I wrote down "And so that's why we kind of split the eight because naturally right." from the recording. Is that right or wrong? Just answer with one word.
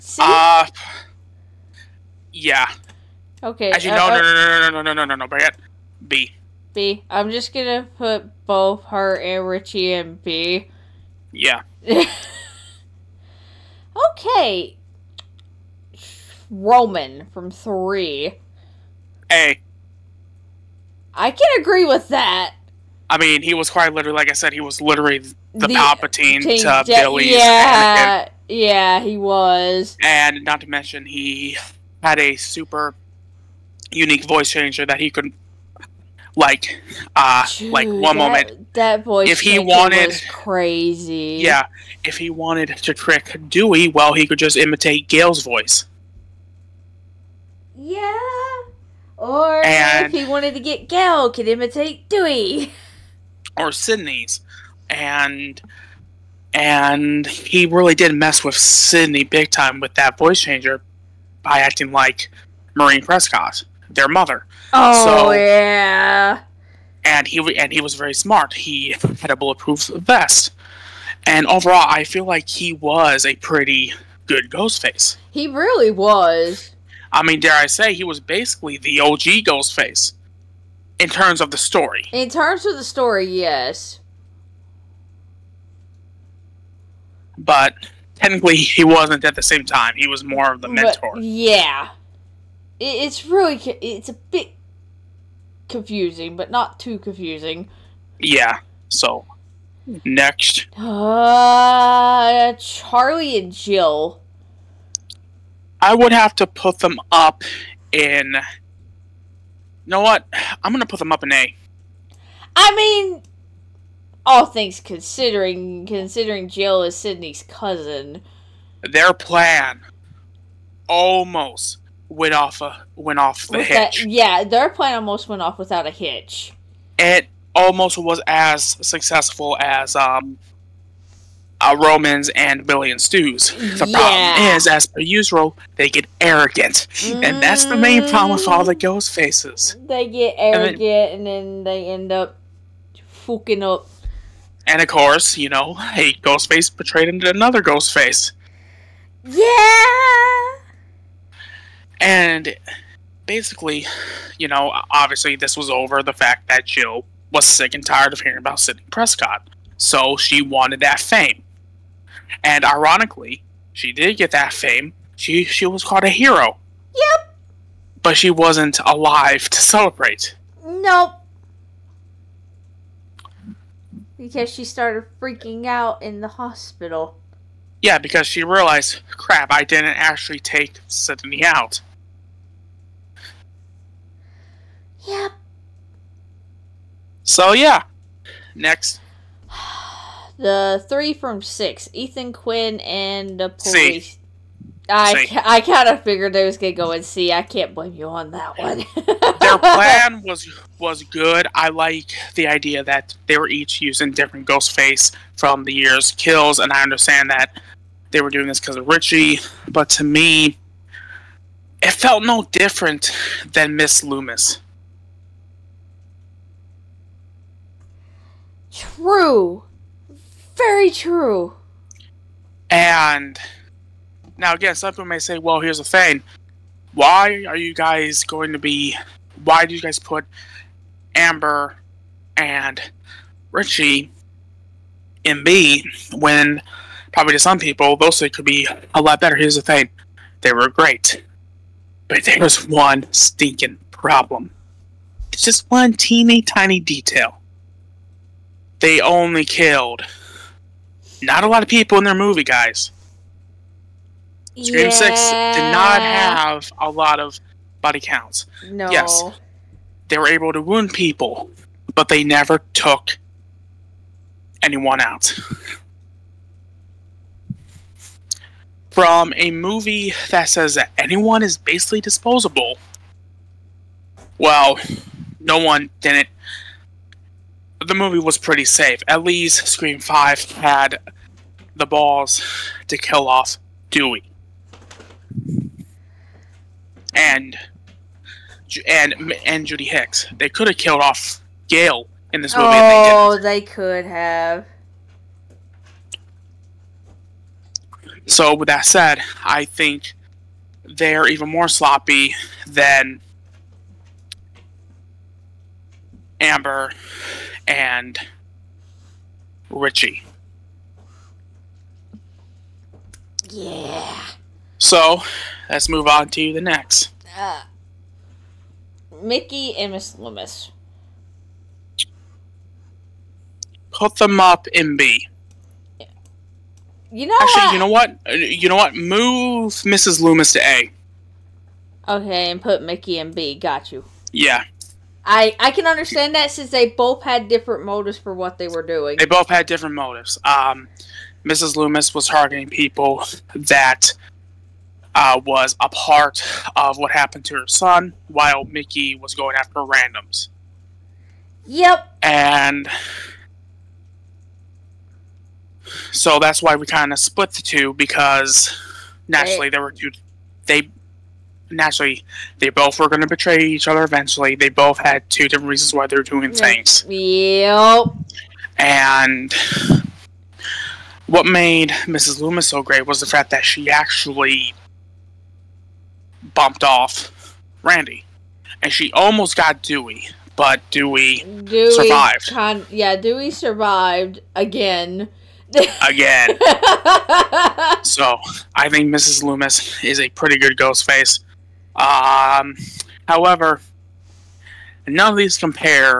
wrong.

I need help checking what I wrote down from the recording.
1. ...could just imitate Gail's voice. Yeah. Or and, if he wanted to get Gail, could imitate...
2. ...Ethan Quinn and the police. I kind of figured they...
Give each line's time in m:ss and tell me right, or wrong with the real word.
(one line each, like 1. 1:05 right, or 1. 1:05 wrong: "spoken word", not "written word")
1. 0:44 right
2. 3:11 right.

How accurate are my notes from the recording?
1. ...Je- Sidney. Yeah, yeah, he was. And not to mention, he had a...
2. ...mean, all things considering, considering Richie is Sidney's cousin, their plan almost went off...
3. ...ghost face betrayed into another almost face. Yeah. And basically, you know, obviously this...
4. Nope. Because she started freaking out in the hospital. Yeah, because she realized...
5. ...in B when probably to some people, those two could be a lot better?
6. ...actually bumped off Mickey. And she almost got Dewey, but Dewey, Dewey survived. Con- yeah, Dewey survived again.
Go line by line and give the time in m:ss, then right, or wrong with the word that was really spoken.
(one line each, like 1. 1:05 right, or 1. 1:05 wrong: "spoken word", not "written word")
1. 0:26 wrong: "Billy", not "Sidney"
2. 1:52 wrong: "Jill", not "Richie"
3. 2:26 wrong: "ghost", not "almost"
4. 2:50 right
5. 3:55 wrong: "three", not "two"
6. 6:13 wrong: "Randy", not "Mickey".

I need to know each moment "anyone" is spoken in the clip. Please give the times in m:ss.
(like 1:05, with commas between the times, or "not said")
4:24, 4:30.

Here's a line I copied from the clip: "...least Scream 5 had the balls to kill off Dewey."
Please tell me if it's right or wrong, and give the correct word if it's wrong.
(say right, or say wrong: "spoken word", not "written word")
right.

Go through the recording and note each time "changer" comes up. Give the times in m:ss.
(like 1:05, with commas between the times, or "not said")
0:34, 1:00.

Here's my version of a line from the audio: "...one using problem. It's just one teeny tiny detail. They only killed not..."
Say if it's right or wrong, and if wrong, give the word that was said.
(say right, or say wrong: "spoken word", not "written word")
wrong: "stinking", not "using".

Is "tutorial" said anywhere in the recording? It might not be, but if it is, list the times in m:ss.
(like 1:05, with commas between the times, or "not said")
not said.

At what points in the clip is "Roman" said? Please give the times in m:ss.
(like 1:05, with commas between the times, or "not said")
0:16, 2:11.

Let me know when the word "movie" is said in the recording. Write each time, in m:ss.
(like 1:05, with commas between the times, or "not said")
4:12, 4:29, 4:37, 4:52.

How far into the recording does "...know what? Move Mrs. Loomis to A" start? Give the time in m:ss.
5:28.